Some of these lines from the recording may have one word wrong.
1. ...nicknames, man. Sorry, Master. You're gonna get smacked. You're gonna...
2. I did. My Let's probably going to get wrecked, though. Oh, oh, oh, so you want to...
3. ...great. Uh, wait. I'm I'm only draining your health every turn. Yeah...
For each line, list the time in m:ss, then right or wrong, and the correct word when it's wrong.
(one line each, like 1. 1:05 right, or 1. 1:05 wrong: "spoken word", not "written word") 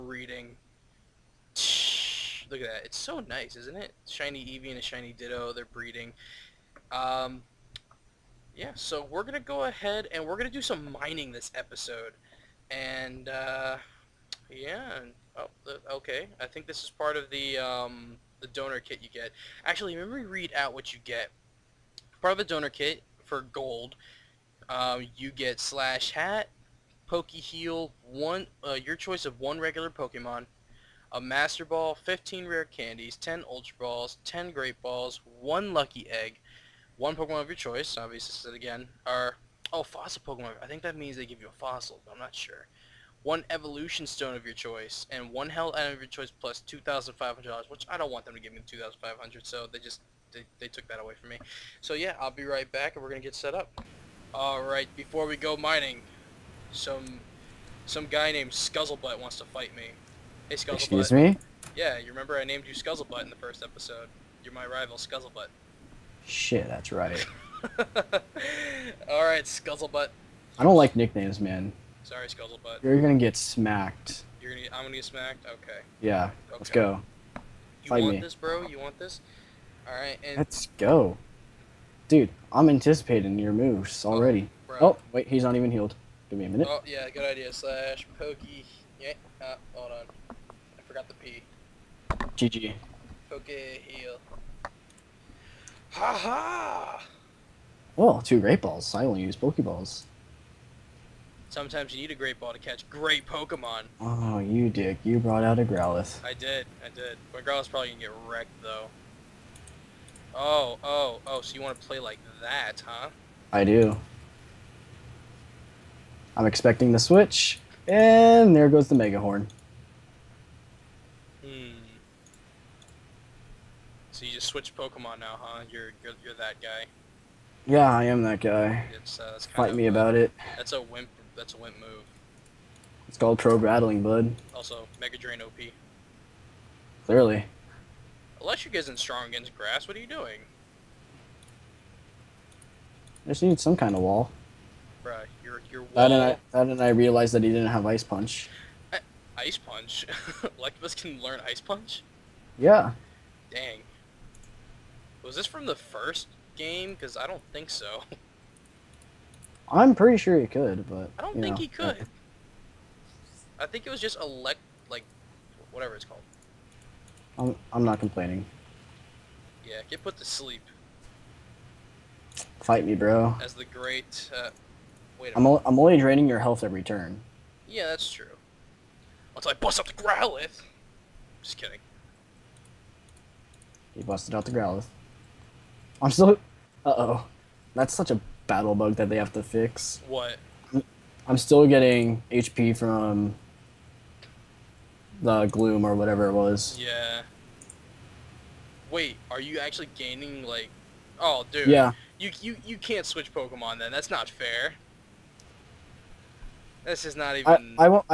1. 1:10 wrong: "Scuttlebutt", not "Master"
2. 1:46 wrong: "Growlithe", not "Let"
3. 2:53 right.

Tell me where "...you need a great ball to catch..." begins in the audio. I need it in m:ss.
1:41.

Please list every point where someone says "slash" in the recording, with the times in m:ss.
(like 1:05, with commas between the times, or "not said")
0:25, 1:27.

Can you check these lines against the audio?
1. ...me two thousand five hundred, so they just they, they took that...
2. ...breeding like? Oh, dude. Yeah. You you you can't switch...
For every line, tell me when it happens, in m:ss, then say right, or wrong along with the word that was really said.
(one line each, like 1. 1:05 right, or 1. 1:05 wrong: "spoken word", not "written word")
1. 0:48 right
2. 3:19 wrong: "gaining", not "breeding".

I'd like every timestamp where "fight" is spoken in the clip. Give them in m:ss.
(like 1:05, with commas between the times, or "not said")
0:59, 1:17, 2:09, 2:52.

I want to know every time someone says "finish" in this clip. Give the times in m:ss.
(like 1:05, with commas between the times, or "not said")
not said.